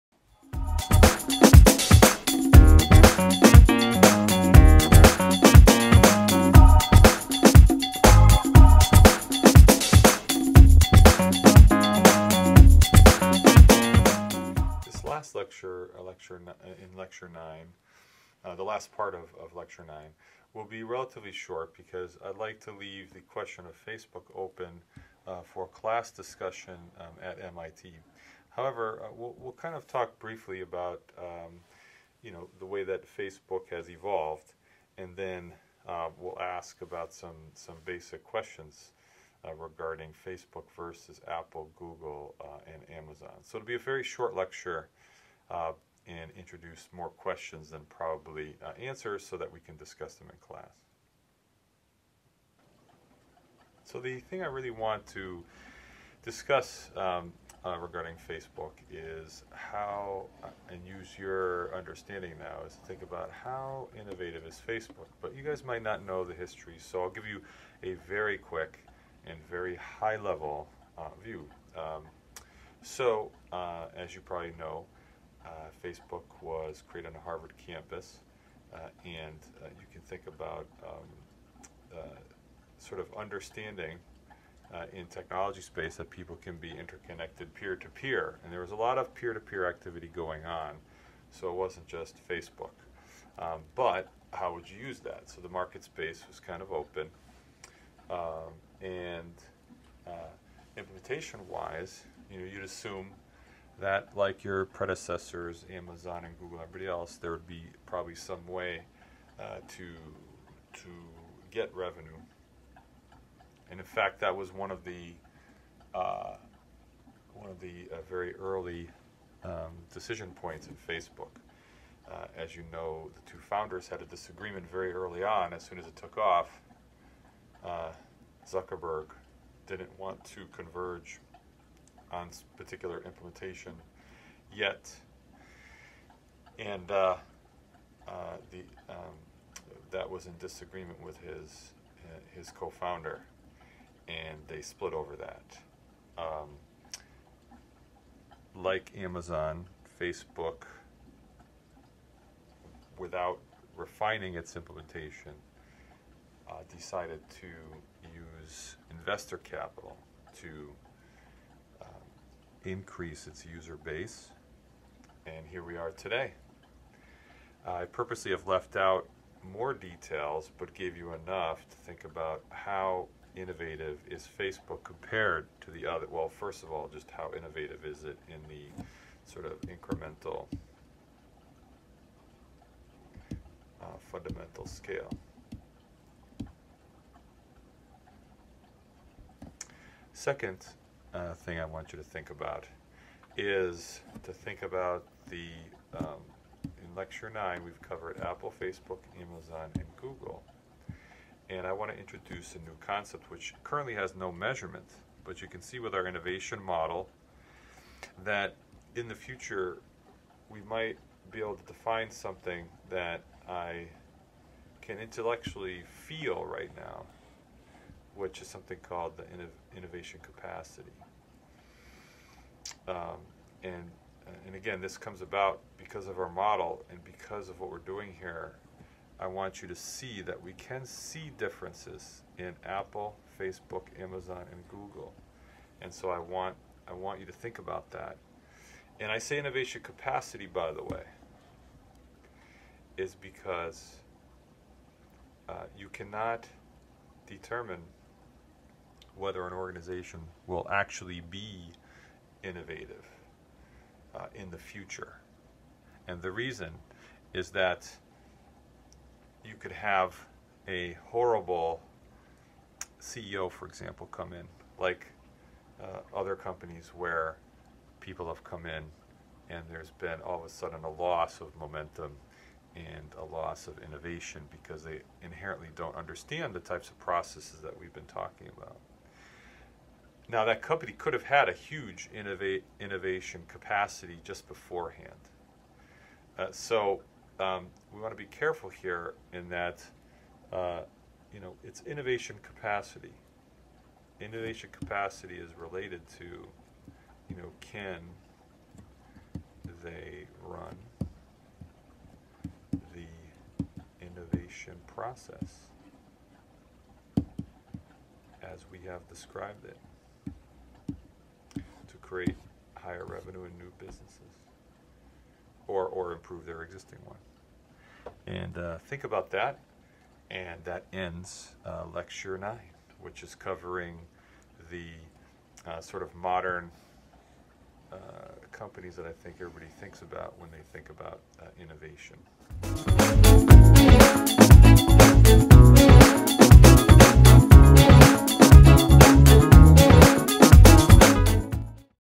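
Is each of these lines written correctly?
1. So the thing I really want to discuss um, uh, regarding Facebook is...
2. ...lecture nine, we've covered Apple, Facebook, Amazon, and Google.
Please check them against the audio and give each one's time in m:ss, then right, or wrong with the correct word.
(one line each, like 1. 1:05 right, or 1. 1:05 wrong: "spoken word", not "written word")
1. 0:53 right
2. 3:16 right.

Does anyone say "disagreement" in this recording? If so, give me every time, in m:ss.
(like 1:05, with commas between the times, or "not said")
2:04, 2:20.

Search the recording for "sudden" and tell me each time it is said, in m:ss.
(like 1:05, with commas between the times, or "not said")
4:30.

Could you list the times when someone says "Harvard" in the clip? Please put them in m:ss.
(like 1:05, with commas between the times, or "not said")
1:17.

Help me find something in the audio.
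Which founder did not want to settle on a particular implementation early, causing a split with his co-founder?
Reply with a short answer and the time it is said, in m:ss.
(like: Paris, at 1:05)
Zuckerberg, at 2:08.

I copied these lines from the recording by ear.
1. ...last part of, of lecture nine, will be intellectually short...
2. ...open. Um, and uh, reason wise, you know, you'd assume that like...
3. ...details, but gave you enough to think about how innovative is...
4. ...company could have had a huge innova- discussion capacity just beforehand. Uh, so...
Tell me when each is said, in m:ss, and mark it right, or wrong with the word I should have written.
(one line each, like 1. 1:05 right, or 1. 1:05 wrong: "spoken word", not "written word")
1. 0:18 wrong: "relatively", not "intellectually"
2. 1:36 wrong: "implementation", not "reason"
3. 2:49 right
4. 4:40 wrong: "innovation", not "discussion".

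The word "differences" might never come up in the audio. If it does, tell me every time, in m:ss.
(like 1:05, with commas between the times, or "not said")
3:51.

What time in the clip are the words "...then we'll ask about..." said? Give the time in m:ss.
0:35.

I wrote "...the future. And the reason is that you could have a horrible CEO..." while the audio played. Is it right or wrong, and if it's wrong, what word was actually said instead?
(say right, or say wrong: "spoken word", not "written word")
right.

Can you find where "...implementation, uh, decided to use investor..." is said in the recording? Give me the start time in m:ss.
2:34.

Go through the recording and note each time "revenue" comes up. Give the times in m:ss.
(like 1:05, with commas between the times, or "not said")
1:51, 5:13.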